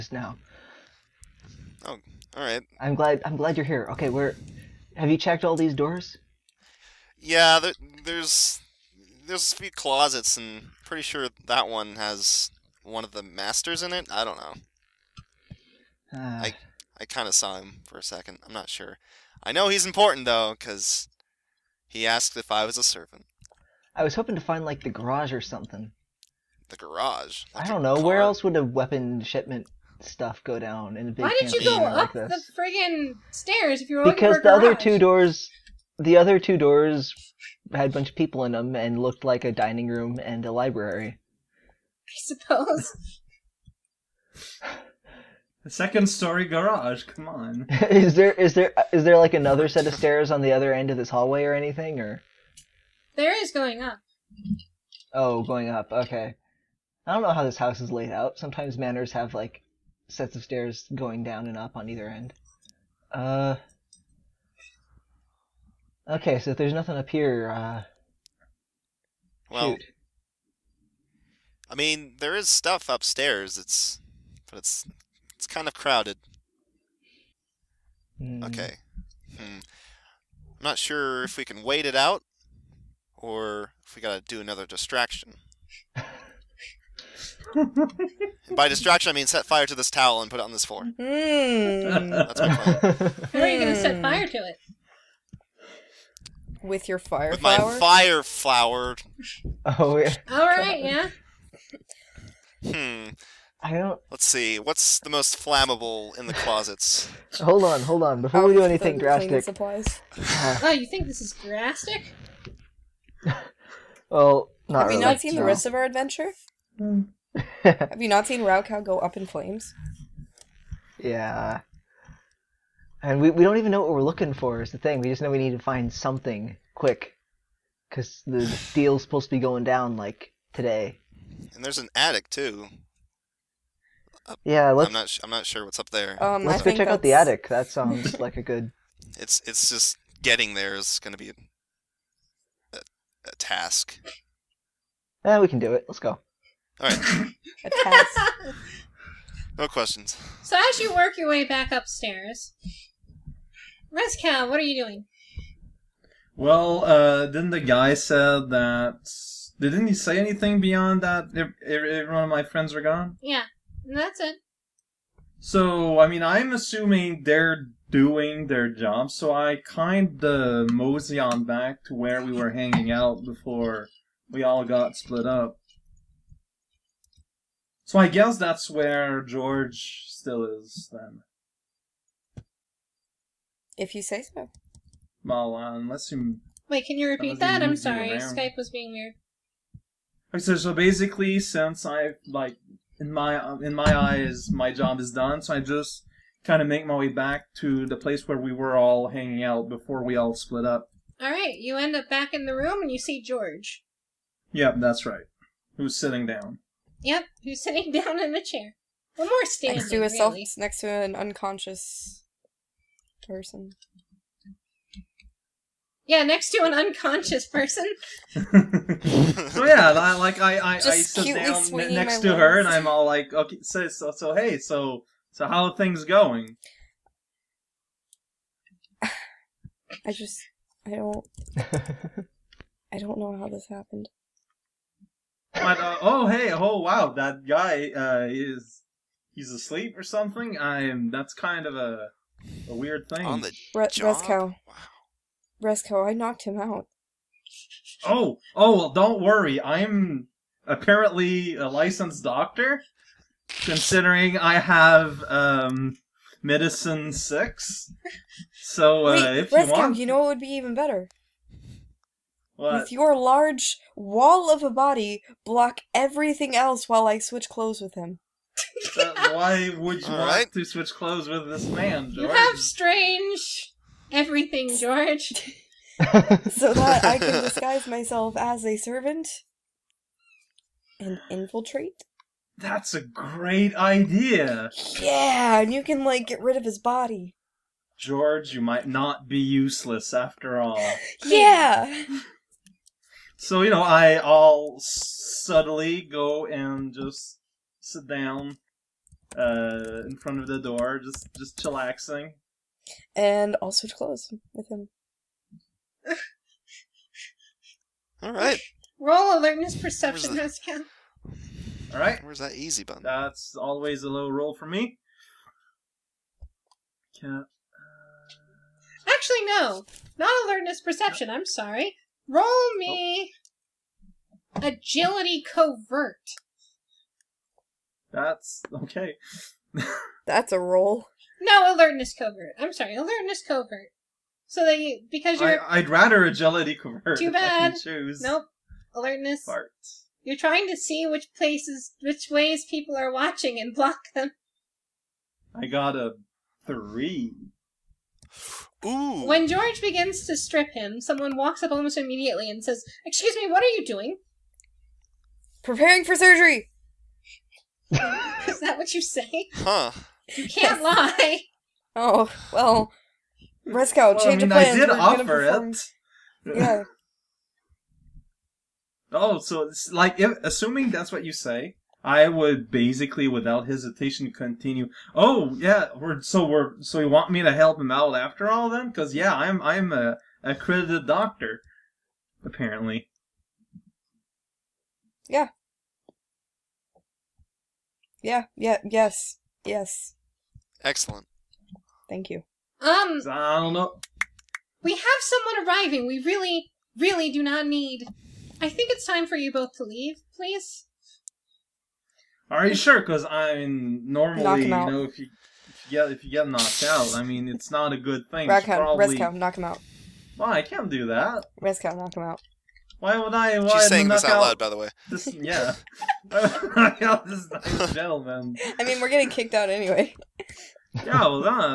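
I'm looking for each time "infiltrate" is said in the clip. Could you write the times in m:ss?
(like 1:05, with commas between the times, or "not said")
4:41.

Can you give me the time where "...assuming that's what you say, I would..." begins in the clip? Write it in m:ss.
6:10.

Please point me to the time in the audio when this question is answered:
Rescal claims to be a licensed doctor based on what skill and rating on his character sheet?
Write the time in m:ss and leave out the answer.
4:16.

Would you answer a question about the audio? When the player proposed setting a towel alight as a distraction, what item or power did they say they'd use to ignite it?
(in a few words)
fire flower.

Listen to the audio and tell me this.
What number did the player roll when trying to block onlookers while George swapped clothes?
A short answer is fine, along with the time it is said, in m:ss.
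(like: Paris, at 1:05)
3, at 5:45.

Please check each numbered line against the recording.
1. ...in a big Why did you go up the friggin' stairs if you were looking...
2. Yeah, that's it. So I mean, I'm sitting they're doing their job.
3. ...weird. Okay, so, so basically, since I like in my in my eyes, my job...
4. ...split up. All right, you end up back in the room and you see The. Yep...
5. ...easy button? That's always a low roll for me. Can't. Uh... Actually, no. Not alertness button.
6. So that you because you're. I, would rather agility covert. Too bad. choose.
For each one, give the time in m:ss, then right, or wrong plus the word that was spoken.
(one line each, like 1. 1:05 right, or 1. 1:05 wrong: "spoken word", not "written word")
1. 0:30 right
2. 2:43 wrong: "assuming", not "sitting"
3. 3:08 right
4. 3:20 wrong: "George", not "The"
5. 5:12 wrong: "perception", not "button"
6. 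5:34 right.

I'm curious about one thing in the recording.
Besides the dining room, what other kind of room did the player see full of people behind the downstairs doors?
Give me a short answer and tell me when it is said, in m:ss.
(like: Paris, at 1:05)
library, at 0:40.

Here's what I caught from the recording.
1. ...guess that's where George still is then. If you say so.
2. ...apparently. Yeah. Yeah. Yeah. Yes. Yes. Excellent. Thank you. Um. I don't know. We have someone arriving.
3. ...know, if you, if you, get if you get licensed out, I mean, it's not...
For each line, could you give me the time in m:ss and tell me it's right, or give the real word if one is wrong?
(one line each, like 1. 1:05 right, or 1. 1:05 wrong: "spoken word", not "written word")
1. 2:58 right
2. 6:22 right
3. 6:44 wrong: "knocked", not "licensed".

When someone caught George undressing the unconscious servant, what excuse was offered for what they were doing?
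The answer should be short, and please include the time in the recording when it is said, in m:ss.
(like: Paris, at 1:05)
preparing for surgery, at 5:55.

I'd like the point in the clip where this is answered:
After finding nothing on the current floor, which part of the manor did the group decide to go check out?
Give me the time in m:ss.
2:17.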